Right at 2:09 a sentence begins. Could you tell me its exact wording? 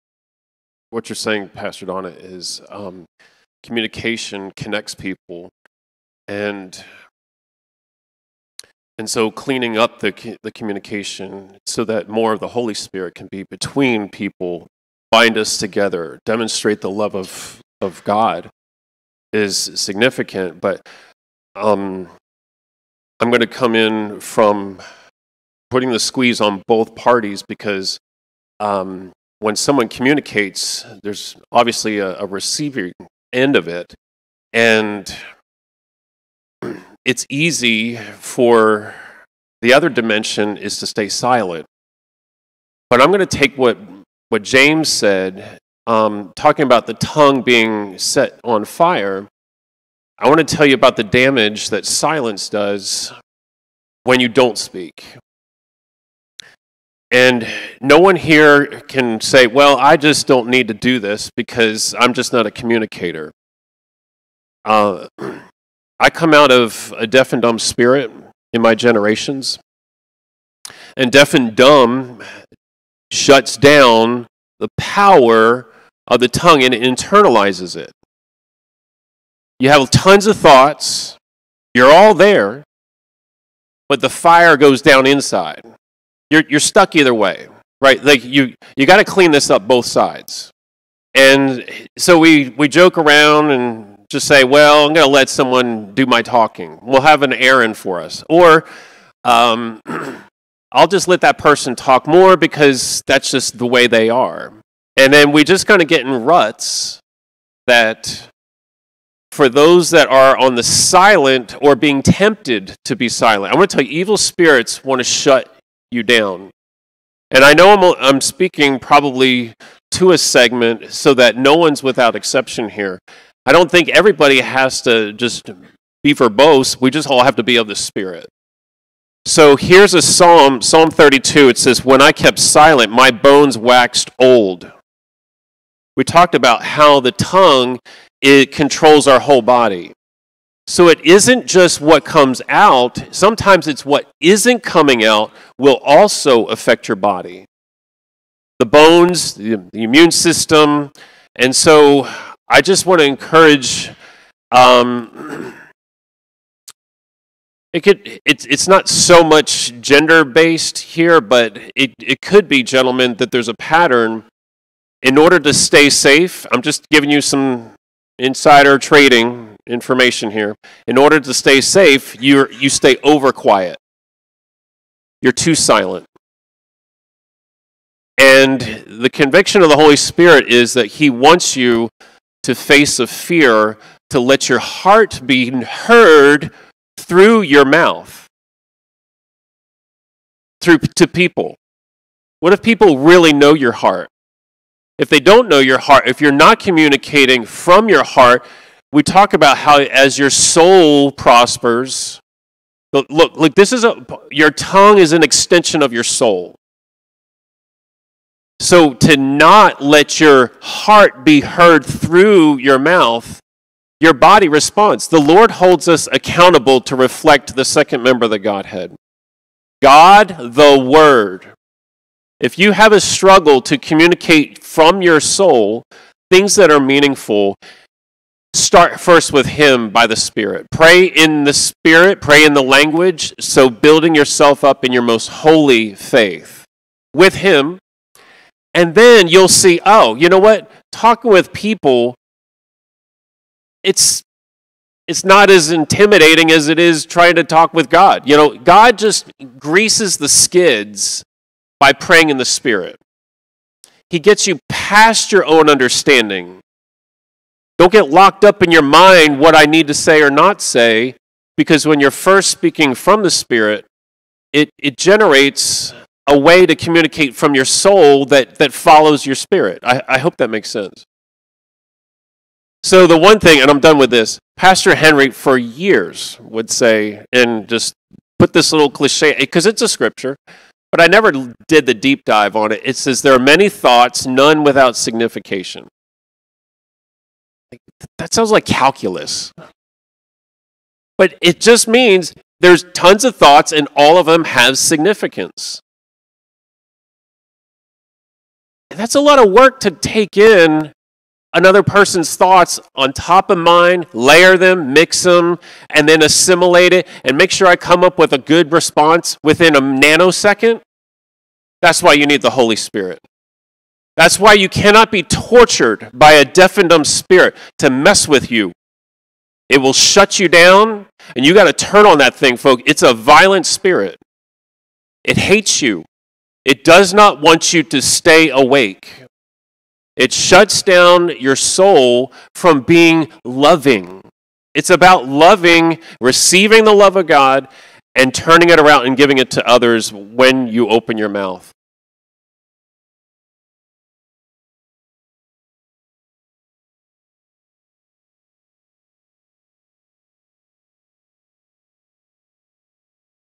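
So here's a psalm, Psalm 32.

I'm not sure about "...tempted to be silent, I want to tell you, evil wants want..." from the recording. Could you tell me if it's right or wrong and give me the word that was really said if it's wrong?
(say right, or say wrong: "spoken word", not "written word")
wrong: "spirits", not "wants".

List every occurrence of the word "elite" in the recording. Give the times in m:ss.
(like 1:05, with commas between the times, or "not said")
not said.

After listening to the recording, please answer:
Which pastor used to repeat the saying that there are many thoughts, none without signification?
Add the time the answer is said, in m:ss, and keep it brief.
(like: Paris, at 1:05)
Pastor Henry, at 4:34.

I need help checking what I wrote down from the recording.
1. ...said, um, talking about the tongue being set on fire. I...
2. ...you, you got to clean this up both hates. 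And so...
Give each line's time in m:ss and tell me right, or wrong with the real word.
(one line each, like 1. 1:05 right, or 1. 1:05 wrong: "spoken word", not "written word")
1. 0:44 right
2. 1:28 wrong: "sides", not "hates".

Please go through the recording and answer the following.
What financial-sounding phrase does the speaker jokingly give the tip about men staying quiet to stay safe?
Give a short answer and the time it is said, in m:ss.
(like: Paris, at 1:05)
insider trading information, at 2:48.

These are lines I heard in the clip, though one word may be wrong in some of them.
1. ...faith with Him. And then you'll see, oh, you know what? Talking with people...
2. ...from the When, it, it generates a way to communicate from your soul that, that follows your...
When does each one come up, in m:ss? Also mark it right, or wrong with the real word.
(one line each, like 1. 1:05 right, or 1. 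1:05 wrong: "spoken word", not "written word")
1. 3:55 right
2. 4:22 wrong: "Spirit", not "When".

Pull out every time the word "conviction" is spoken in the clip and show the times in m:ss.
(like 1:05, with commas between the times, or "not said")
2:59.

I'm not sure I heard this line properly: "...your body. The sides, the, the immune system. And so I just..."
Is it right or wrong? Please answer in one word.
wrong.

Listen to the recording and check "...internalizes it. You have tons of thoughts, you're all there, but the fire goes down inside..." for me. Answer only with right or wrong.
right.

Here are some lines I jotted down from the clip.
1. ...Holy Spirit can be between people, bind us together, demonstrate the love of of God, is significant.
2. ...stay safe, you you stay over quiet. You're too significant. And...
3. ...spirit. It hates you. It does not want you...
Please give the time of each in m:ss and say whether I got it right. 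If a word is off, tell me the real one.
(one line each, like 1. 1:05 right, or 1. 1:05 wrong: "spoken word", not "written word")
1. 0:12 right
2. 2:51 wrong: "silent", not "significant"
3. 5:23 right.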